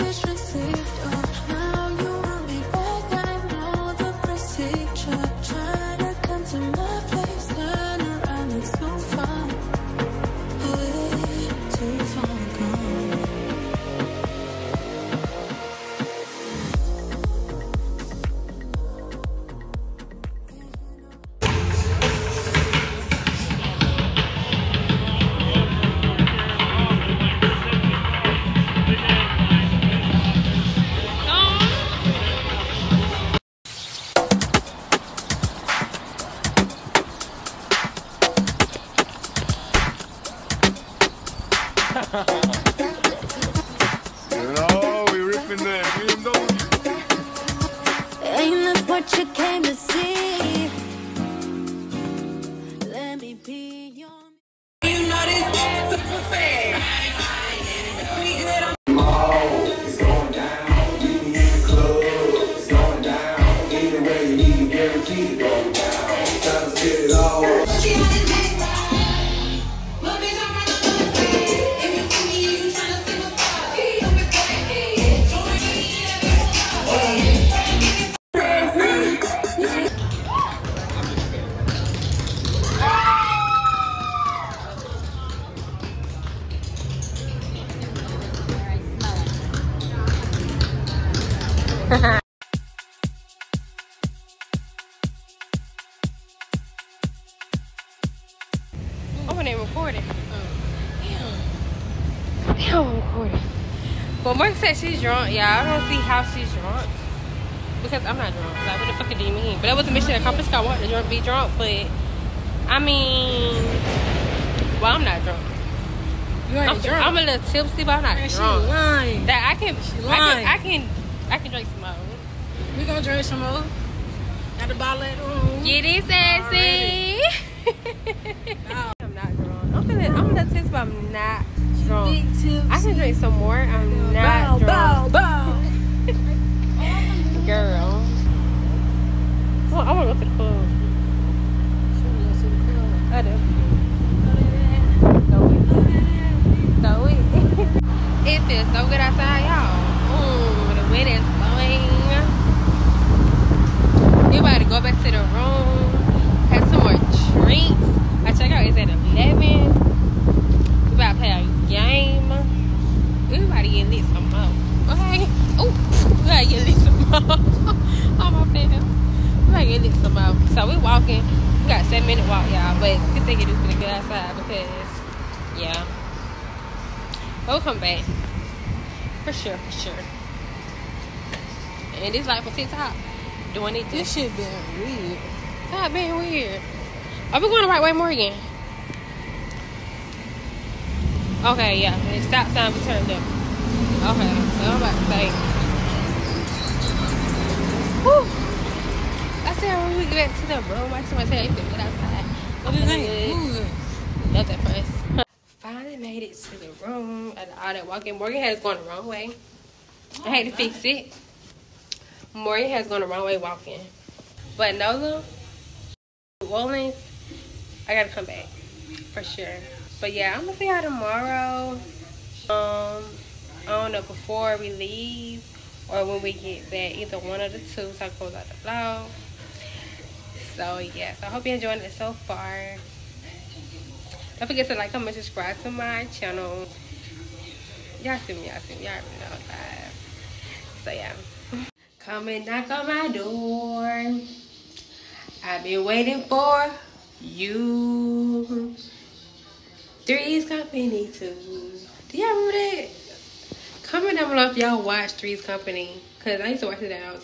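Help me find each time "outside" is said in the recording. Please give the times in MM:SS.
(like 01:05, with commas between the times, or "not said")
02:28, 02:53, 03:21.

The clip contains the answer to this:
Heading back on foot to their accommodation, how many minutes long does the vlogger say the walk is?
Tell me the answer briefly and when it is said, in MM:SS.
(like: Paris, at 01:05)
7, at 02:51.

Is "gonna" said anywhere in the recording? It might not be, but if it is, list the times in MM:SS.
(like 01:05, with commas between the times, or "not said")
02:02, 02:53, 03:40.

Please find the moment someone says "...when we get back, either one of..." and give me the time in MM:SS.
03:46.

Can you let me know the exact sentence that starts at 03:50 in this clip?
So yeah, so I hope you're enjoying it so far.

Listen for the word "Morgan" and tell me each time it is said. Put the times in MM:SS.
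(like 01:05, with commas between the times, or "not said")
03:28, 03:32.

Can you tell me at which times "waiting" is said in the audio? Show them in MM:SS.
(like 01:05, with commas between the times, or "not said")
04:05.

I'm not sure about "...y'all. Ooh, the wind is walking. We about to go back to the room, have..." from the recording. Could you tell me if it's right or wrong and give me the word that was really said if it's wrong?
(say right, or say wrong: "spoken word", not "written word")
wrong: "blowing", not "walking".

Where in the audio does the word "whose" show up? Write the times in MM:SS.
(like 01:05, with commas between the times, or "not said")
not said.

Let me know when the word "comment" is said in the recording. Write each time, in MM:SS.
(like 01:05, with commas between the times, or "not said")
03:54, 04:13.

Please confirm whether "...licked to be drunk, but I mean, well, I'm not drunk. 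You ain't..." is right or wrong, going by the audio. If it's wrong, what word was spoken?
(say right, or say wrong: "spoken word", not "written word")
wrong: "wanted", not "licked".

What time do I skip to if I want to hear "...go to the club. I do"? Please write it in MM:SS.
02:20.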